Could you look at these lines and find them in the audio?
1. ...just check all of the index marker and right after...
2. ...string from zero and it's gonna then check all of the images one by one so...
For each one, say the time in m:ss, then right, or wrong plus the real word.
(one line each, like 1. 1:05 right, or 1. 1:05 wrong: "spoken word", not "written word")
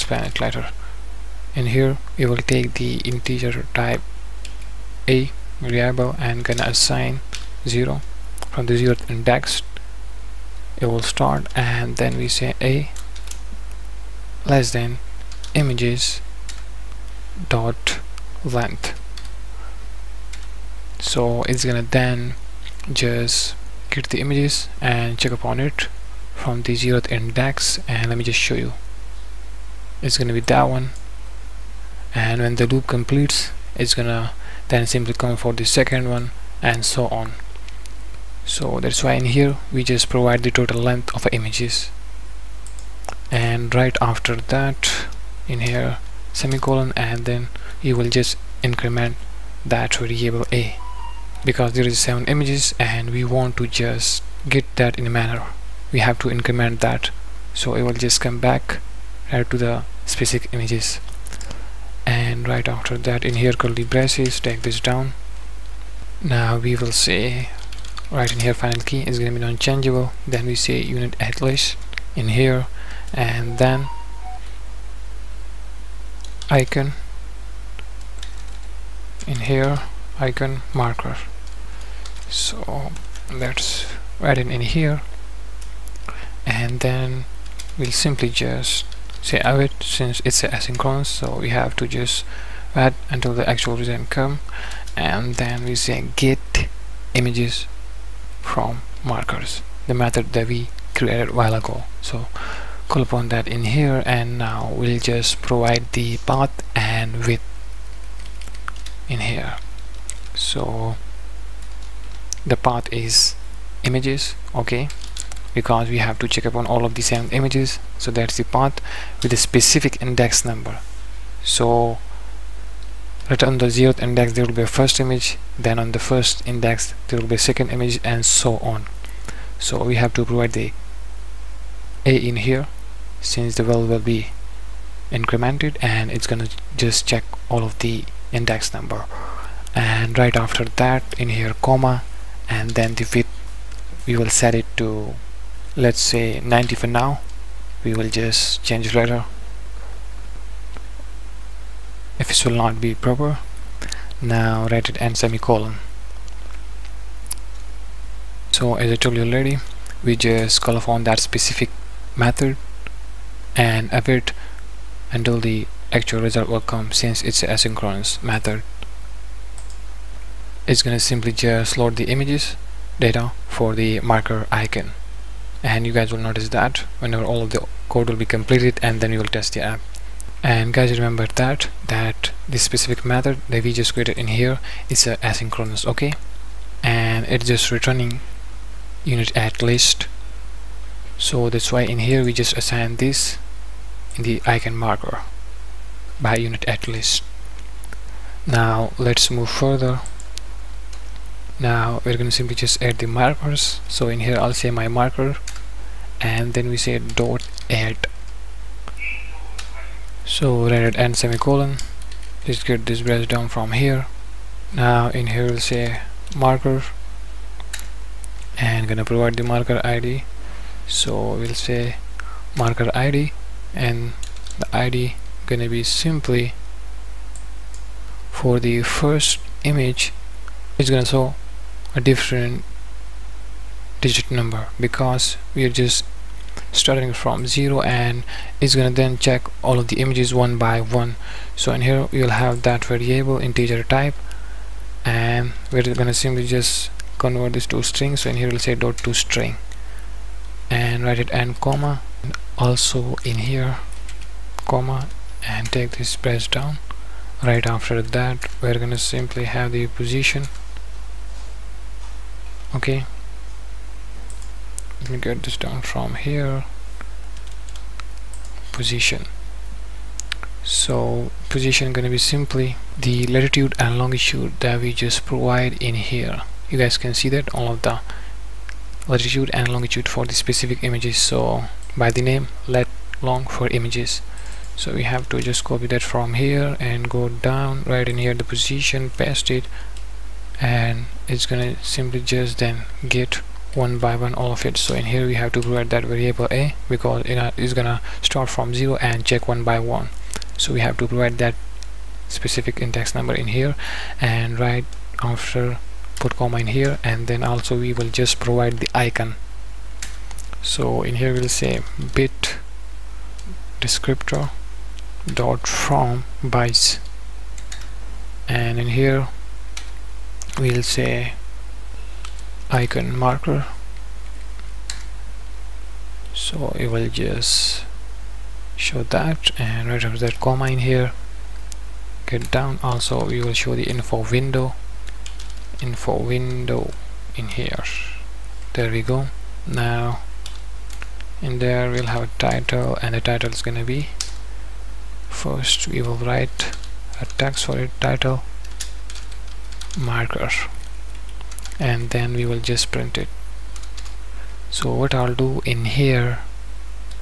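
1. 2:16 wrong: "number", not "marker"
2. 3:56 wrong: "starting", not "string".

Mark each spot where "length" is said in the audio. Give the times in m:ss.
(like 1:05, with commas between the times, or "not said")
0:18, 0:40.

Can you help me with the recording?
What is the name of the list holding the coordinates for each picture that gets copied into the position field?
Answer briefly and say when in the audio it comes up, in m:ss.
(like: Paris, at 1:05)
lat long for images, at 4:42.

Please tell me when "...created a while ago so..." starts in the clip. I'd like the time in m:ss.
1:40.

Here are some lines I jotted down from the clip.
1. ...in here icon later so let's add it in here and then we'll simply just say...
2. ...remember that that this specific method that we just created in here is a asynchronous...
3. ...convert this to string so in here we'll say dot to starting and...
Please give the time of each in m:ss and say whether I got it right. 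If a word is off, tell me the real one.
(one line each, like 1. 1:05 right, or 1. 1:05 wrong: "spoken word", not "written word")
1. 1:19 wrong: "marker", not "later"
2. 3:00 right
3. 4:07 wrong: "string", not "starting".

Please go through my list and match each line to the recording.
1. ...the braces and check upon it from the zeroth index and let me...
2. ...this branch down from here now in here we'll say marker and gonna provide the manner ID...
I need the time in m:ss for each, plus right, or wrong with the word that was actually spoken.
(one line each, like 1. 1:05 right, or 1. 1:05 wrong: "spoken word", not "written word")
1. 0:24 wrong: "images", not "braces"
2. 3:32 wrong: "marker", not "manner".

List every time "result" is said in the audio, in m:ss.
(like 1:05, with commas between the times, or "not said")
1:33, 2:46.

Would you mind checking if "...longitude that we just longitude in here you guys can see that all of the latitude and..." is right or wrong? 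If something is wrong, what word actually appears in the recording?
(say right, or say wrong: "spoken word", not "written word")
wrong: "provide", not "longitude".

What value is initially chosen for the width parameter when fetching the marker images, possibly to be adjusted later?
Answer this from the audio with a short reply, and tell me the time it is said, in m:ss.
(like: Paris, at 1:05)
90, at 2:26.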